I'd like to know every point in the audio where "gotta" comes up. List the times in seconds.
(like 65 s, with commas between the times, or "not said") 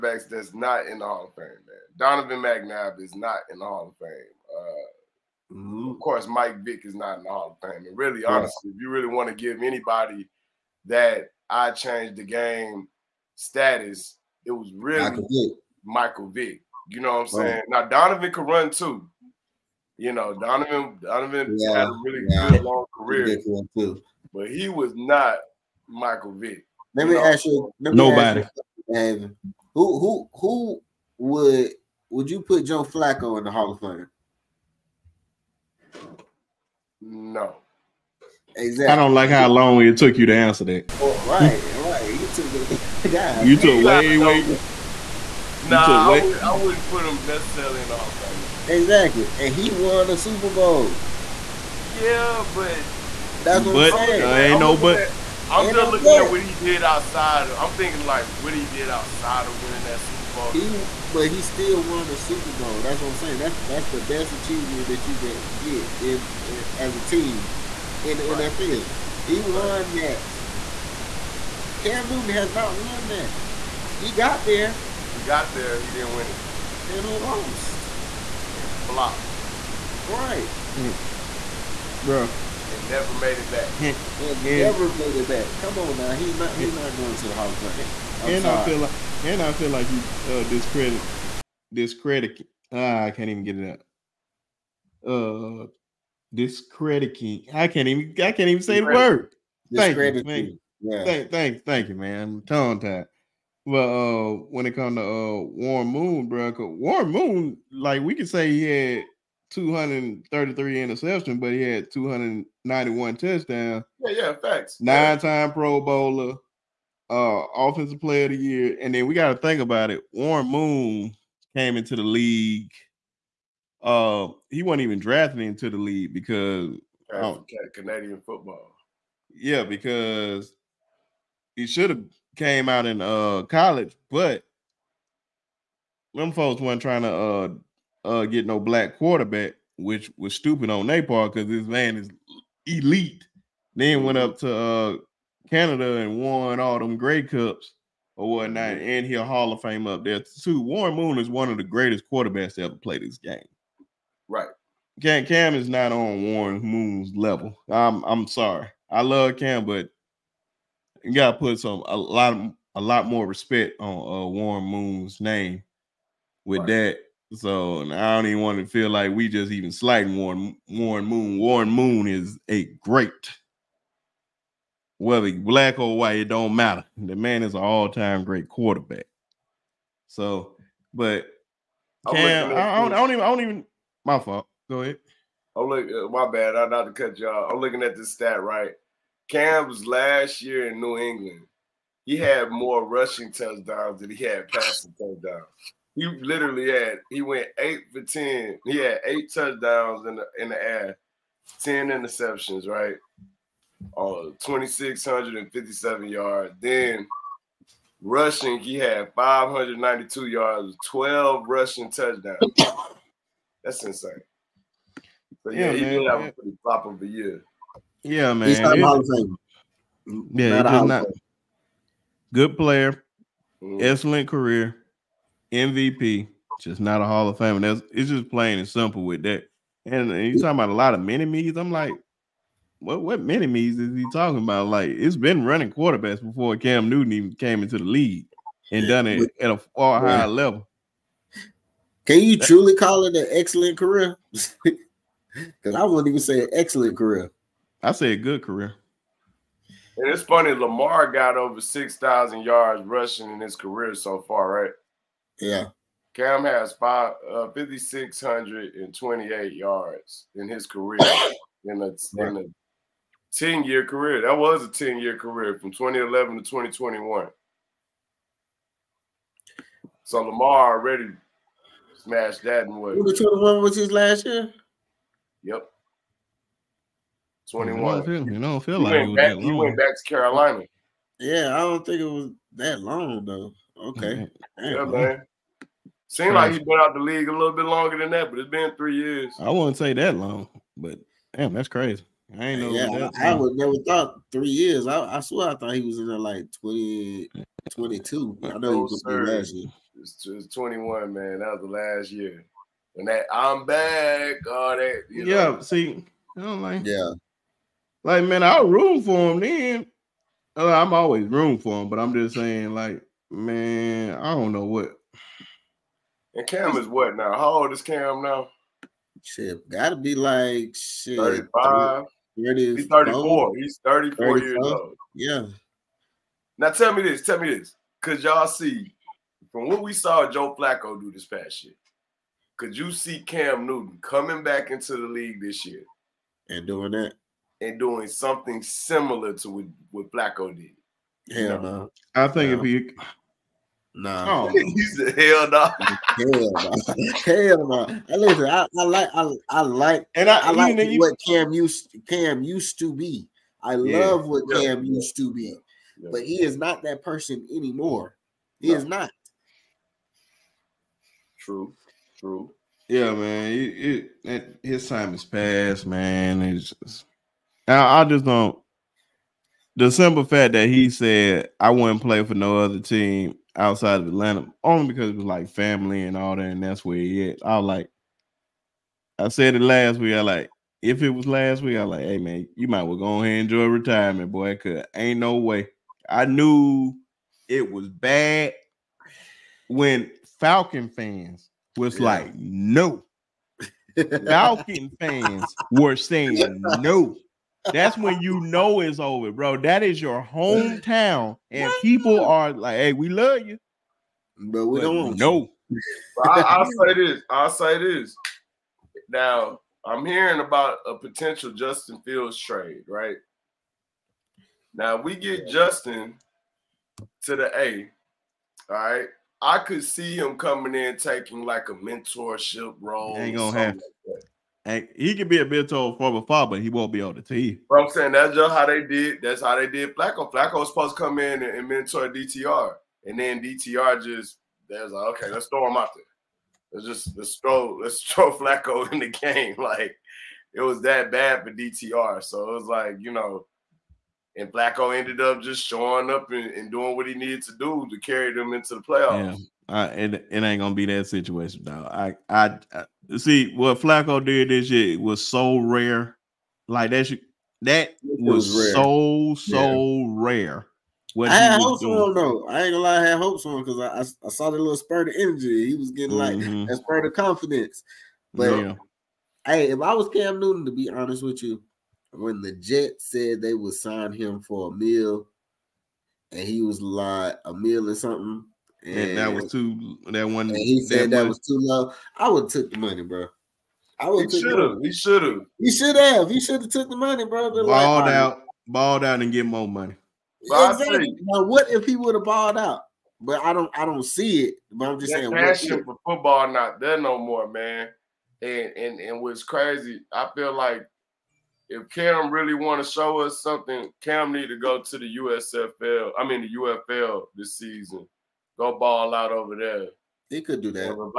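161 s, 319 s.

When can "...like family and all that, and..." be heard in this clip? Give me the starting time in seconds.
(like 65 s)
375 s.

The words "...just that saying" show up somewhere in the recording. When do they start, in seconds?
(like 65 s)
495 s.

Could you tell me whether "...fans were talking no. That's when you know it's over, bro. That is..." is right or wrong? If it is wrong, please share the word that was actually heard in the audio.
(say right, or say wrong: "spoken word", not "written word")
wrong: "saying", not "talking".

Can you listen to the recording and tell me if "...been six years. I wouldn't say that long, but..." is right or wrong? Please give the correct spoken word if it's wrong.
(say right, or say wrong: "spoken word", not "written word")
wrong: "three", not "six".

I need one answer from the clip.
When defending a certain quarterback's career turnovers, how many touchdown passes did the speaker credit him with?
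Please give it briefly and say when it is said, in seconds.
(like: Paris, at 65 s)
291, at 111 s.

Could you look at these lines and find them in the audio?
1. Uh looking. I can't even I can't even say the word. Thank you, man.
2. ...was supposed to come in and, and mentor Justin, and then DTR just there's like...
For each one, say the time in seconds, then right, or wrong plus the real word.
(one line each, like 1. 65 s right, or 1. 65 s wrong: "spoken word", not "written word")
1. 95 s wrong: "discrediting", not "looking"
2. 430 s wrong: "DTR", not "Justin".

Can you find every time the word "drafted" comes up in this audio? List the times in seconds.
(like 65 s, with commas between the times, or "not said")
124 s.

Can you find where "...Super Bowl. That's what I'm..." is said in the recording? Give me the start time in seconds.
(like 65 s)
62 s.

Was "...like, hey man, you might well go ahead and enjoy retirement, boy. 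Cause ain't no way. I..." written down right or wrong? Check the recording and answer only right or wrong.
right.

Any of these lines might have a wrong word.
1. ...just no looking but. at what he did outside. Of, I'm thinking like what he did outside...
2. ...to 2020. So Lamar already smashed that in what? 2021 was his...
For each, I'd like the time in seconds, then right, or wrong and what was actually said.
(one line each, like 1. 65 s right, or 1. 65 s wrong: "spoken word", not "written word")
1. 55 s right
2. 266 s wrong: "2021", not "2020".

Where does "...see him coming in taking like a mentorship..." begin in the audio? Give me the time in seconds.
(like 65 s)
419 s.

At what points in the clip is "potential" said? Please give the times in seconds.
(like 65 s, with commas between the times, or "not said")
410 s.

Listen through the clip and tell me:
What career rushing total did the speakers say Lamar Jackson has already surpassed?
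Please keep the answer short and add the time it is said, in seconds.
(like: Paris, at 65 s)
6,000 yards, at 251 s.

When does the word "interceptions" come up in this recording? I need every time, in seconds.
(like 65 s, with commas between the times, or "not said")
110 s, 201 s.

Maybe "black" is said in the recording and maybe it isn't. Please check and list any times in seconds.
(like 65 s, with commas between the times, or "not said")
138 s, 175 s.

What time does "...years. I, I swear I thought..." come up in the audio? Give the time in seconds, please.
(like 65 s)
294 s.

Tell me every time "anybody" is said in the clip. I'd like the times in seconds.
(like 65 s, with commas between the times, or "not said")
9 s.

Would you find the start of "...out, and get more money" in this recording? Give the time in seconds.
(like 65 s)
489 s.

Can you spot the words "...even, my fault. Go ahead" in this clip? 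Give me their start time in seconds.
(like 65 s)
183 s.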